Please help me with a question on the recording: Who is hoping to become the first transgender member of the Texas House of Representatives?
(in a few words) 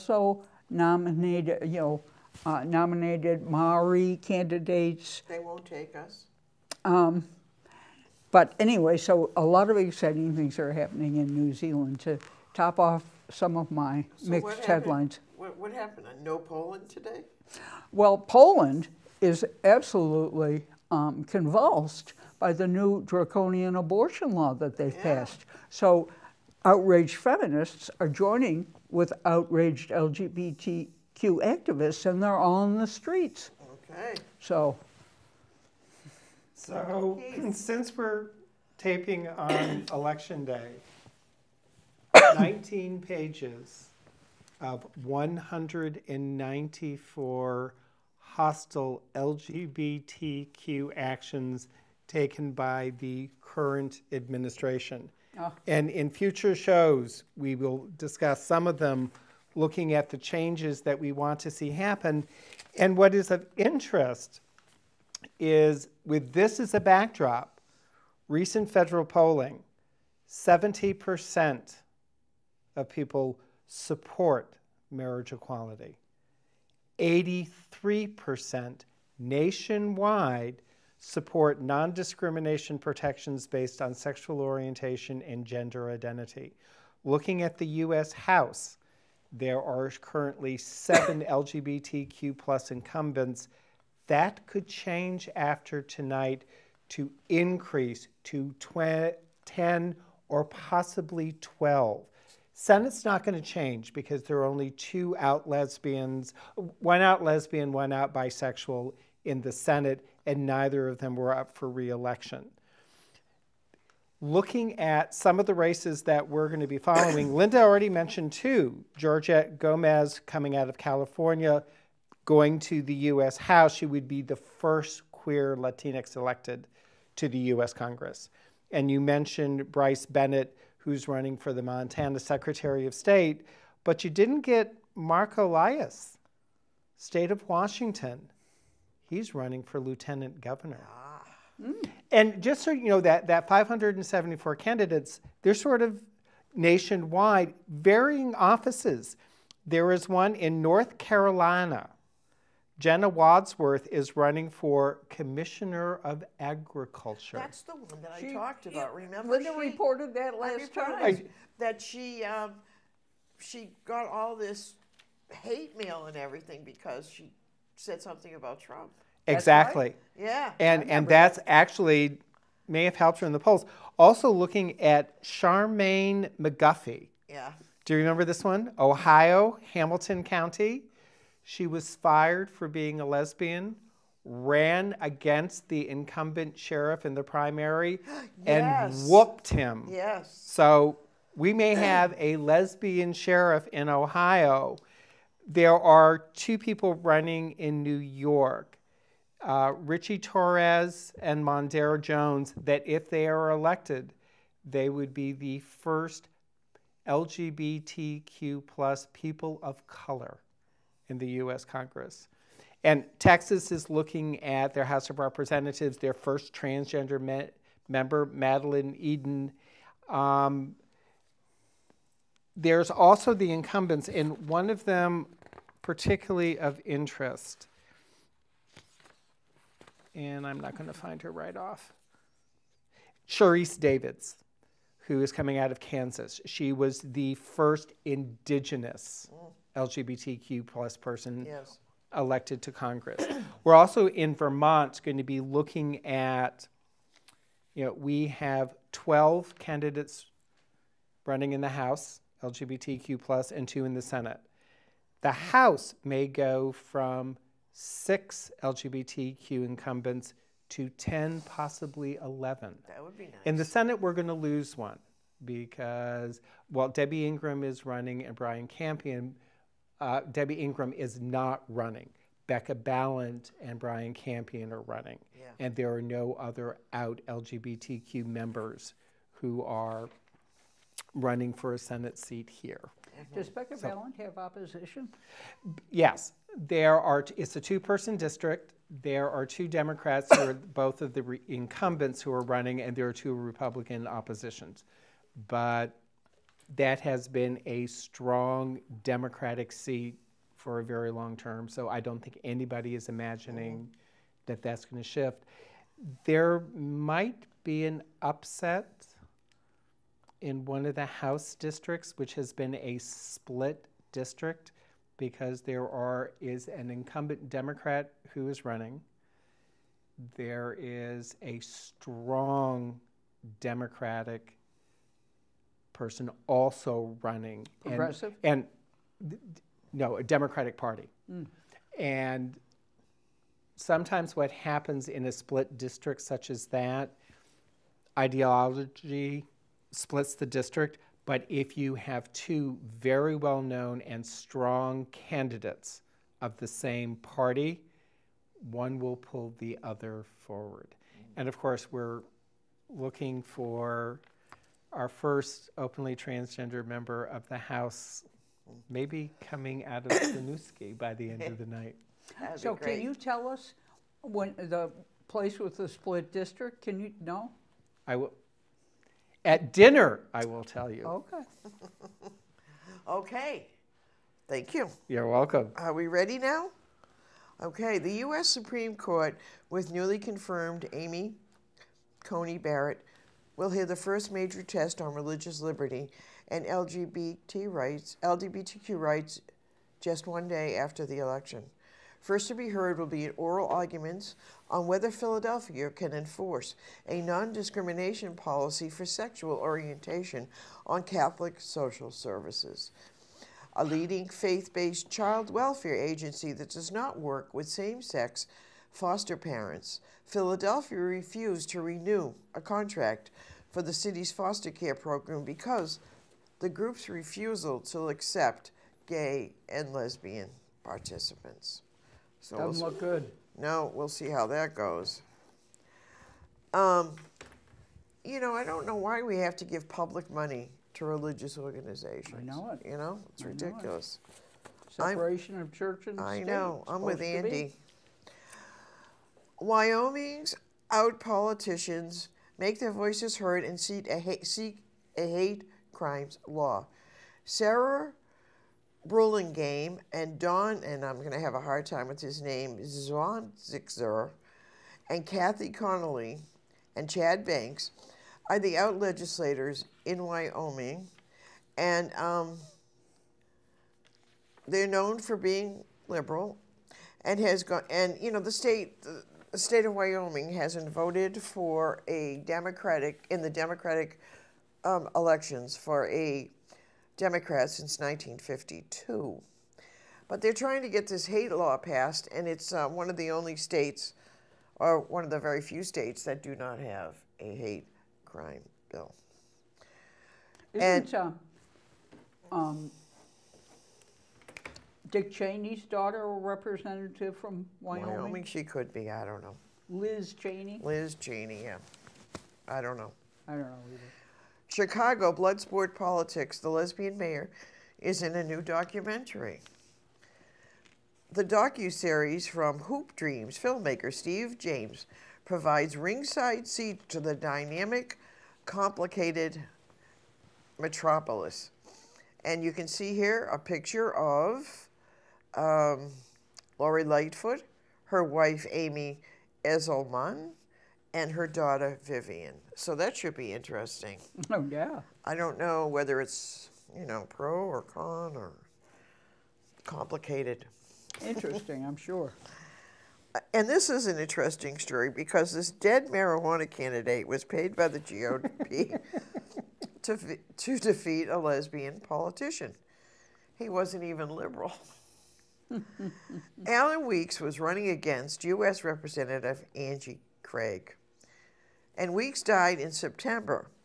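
Madeline Eden.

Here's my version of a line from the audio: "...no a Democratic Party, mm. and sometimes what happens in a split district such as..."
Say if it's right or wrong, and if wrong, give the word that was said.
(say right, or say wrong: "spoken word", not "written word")
right.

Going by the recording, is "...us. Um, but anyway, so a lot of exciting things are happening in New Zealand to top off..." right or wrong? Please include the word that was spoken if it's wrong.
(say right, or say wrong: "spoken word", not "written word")
right.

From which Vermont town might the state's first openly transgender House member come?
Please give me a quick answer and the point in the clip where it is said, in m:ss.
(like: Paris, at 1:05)
Winooski, at 6:00.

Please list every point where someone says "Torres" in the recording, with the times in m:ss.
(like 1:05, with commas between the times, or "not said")
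3:20.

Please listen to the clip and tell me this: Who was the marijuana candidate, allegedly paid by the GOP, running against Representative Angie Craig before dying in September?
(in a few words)
Alan Weeks.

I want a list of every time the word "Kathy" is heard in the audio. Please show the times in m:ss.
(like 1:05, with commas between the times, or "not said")
7:35.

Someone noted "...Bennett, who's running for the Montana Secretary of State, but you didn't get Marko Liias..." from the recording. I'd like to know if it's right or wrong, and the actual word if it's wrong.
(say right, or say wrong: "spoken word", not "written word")
right.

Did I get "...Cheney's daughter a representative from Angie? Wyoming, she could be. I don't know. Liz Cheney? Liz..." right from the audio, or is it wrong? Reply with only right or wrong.
wrong.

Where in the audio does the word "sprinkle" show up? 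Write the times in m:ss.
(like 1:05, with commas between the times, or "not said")
not said.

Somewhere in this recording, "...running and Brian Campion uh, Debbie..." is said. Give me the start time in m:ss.
4:27.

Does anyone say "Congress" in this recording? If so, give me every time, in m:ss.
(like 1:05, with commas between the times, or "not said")
2:07, 3:31, 4:02.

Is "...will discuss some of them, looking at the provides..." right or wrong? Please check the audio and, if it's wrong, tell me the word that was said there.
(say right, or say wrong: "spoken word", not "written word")
wrong: "changes", not "provides".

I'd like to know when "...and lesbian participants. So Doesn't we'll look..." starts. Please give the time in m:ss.
6:59.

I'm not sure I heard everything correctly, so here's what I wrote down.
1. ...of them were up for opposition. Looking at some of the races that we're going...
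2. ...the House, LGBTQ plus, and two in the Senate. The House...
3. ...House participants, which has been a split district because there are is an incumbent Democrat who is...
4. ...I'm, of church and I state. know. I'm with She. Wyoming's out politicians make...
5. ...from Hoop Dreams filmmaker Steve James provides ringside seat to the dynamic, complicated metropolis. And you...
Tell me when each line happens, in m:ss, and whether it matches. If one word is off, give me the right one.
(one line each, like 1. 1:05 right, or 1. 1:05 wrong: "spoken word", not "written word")
1. 1:50 wrong: "reelection", not "opposition"
2. 4:11 right
3. 5:11 wrong: "districts", not "participants"
4. 7:15 wrong: "Andy", not "She"
5. 8:32 right.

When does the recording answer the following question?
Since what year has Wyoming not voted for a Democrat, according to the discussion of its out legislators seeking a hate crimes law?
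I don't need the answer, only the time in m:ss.
7:57.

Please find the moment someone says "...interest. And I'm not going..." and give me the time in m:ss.
3:46.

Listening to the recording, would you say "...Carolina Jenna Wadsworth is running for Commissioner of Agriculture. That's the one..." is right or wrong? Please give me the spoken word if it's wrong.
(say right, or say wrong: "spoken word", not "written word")
right.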